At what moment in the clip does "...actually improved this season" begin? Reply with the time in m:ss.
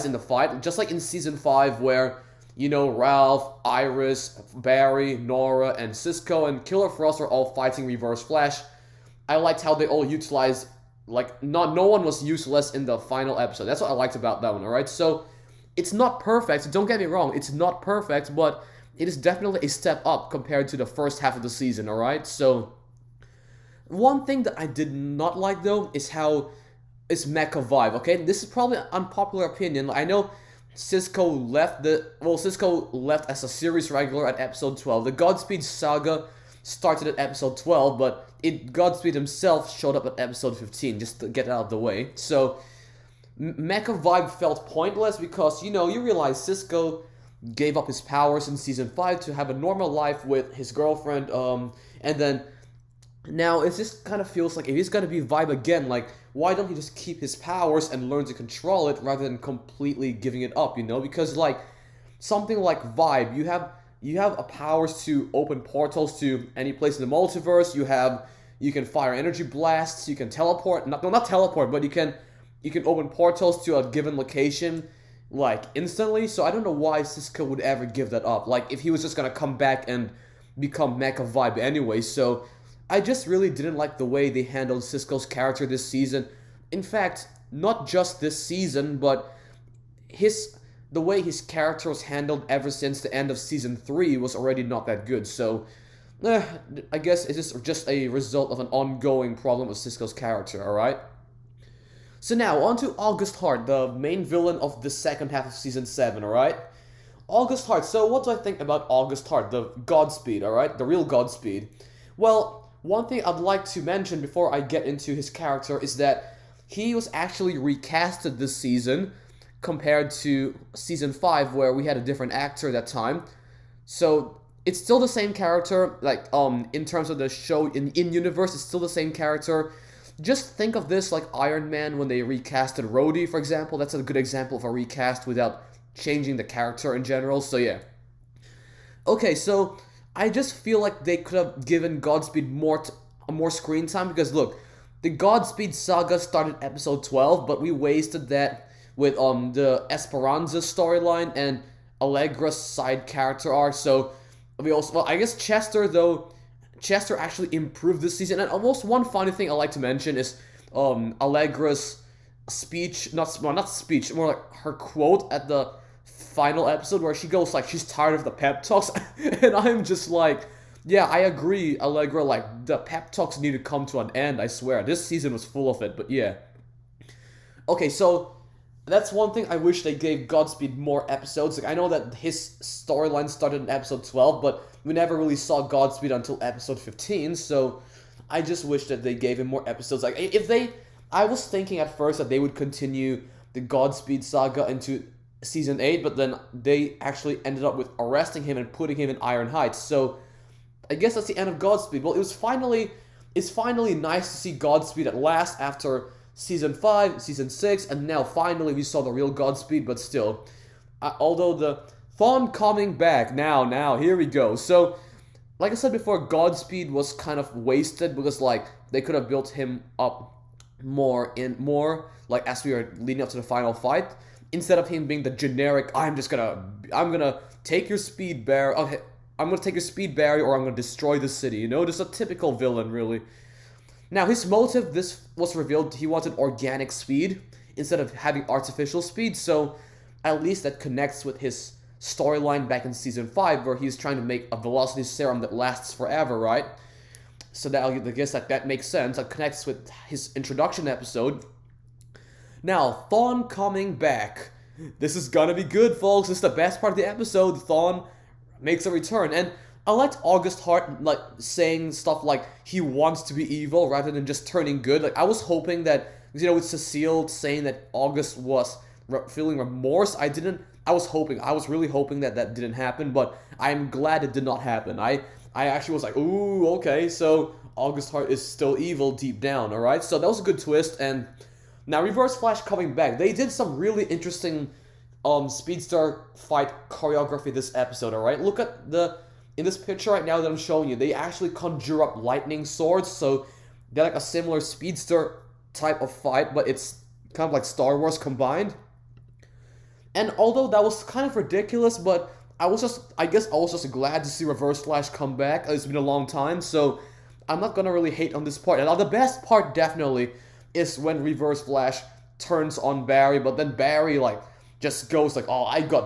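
2:37.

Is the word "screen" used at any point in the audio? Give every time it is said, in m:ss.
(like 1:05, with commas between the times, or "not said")
2:23.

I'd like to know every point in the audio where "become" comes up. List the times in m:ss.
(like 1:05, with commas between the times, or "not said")
1:20.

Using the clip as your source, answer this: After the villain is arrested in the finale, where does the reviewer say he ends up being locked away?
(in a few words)
Iron Heights.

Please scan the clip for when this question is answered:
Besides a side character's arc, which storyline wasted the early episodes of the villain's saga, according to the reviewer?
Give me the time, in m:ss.
2:29.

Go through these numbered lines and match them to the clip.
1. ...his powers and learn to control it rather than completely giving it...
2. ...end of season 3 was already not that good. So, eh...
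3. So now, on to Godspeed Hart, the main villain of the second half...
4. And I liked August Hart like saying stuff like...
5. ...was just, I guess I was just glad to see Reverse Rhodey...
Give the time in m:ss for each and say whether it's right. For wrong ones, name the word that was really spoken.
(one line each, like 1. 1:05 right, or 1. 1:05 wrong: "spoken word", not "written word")
1. 0:57 right
2. 1:33 right
3. 1:42 wrong: "August", not "Godspeed"
4. 4:19 right
5. 5:02 wrong: "Flash", not "Rhodey".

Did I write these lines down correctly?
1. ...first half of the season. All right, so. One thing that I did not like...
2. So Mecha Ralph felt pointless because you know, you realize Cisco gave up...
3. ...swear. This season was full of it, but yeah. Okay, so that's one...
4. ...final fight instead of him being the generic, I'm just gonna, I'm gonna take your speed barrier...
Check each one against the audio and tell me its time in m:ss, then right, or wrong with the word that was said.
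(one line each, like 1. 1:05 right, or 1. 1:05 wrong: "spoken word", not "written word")
1. 0:20 right
2. 0:42 wrong: "Vibe", not "Ralph"
3. 2:54 right
4. 3:43 right.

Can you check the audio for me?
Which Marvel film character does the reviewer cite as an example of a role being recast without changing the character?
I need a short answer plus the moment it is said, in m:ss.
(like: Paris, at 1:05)
Rhodey, at 2:12.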